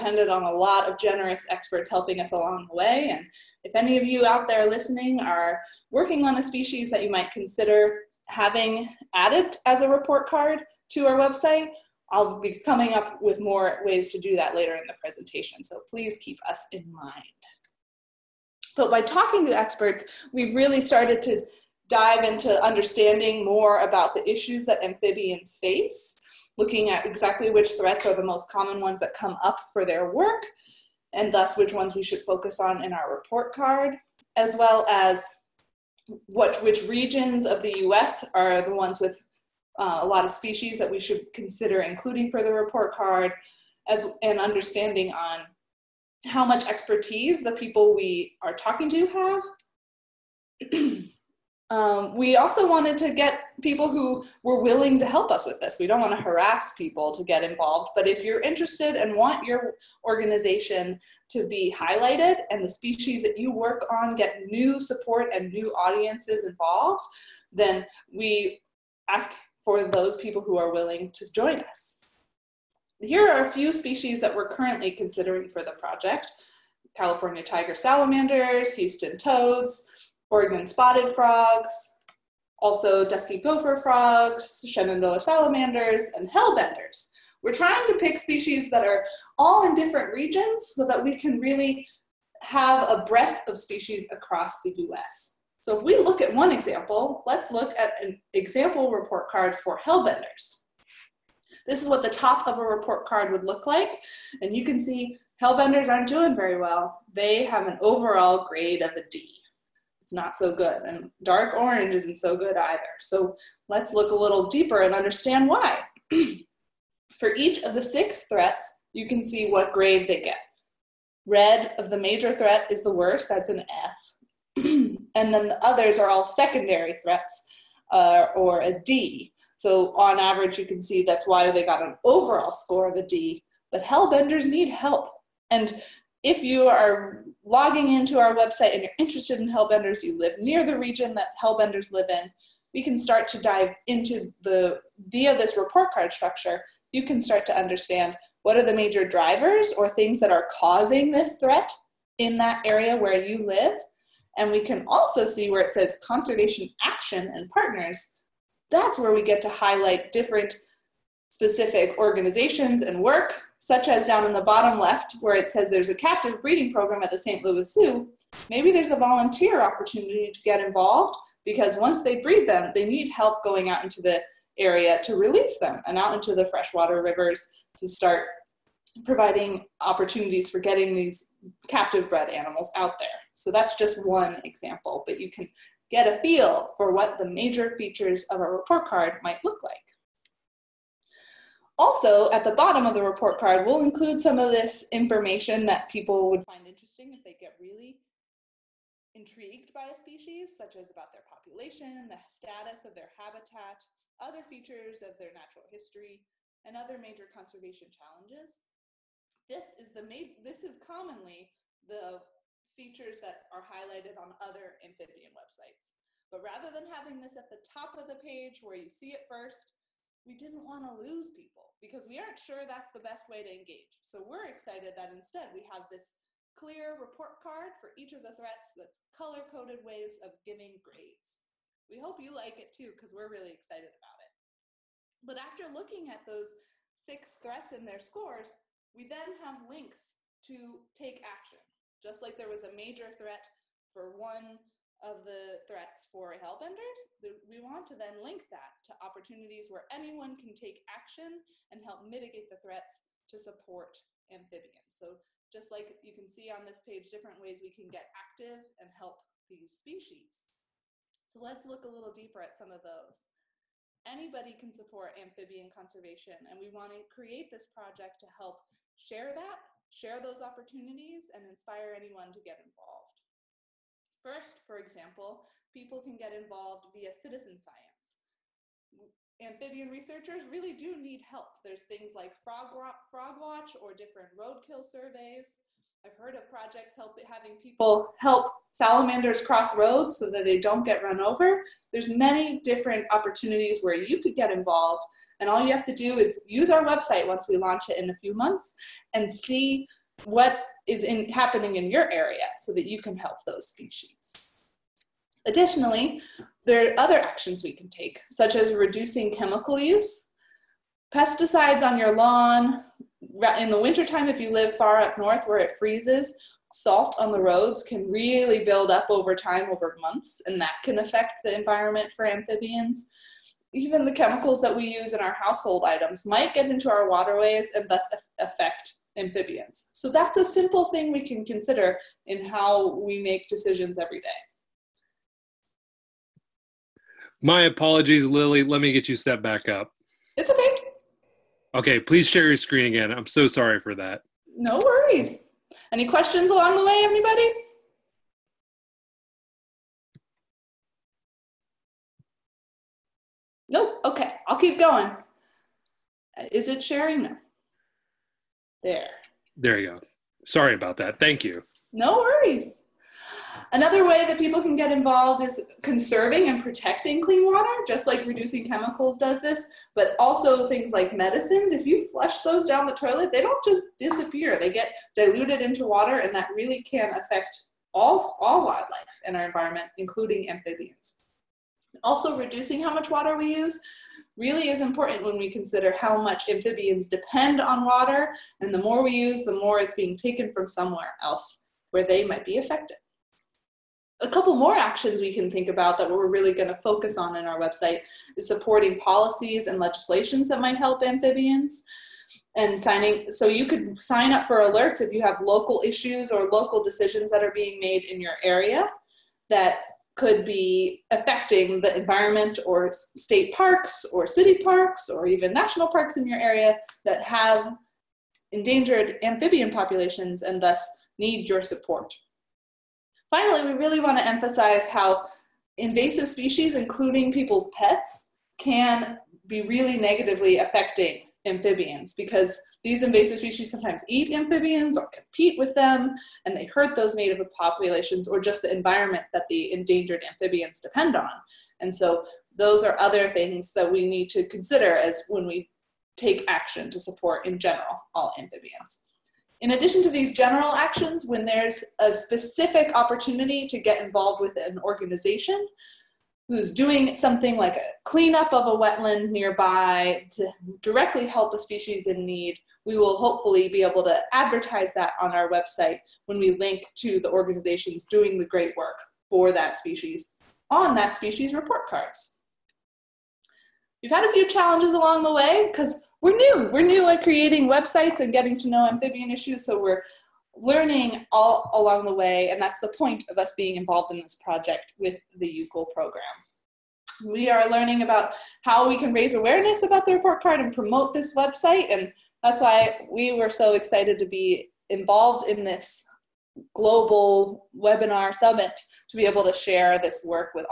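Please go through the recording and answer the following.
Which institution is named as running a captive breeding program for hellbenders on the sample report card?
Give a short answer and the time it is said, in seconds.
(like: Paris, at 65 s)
St. Louis Zoo, at 167 s.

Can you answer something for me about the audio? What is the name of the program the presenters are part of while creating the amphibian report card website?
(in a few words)
EWCL.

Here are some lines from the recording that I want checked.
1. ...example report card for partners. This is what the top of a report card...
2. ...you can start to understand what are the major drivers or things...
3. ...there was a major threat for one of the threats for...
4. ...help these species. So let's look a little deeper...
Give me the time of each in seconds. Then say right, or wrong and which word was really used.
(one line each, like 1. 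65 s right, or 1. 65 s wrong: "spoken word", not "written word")
1. 98 s wrong: "hellbenders", not "partners"
2. 146 s right
3. 242 s right
4. 258 s right.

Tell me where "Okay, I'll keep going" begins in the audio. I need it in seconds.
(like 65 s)
354 s.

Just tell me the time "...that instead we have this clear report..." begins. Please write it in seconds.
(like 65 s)
224 s.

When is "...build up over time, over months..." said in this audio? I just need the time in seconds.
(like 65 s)
318 s.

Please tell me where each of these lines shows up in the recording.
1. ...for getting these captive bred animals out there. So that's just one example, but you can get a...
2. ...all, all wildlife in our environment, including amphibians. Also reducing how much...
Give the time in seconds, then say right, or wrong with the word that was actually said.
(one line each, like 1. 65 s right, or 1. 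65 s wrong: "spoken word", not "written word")
1. 180 s right
2. 377 s right.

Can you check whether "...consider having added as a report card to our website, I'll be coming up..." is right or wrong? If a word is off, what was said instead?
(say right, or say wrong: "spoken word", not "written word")
right.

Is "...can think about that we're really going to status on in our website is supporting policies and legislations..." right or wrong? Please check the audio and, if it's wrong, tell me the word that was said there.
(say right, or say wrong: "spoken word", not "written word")
wrong: "focus", not "status".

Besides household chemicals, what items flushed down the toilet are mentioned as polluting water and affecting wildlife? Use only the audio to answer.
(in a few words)
Medicines.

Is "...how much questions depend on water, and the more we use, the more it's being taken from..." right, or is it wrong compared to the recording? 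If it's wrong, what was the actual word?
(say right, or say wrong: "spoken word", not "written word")
wrong: "amphibians", not "questions".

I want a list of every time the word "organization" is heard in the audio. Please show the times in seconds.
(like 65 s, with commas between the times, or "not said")
60 s, 161 s, 454 s, 467 s.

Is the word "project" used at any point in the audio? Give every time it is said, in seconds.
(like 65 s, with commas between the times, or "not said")
75 s, 267 s, 286 s, 484 s.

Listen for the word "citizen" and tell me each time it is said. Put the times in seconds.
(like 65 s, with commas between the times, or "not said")
277 s.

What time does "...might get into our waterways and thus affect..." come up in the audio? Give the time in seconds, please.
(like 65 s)
326 s.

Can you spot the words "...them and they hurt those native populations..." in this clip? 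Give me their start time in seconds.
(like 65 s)
435 s.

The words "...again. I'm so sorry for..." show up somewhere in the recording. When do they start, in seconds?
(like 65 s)
342 s.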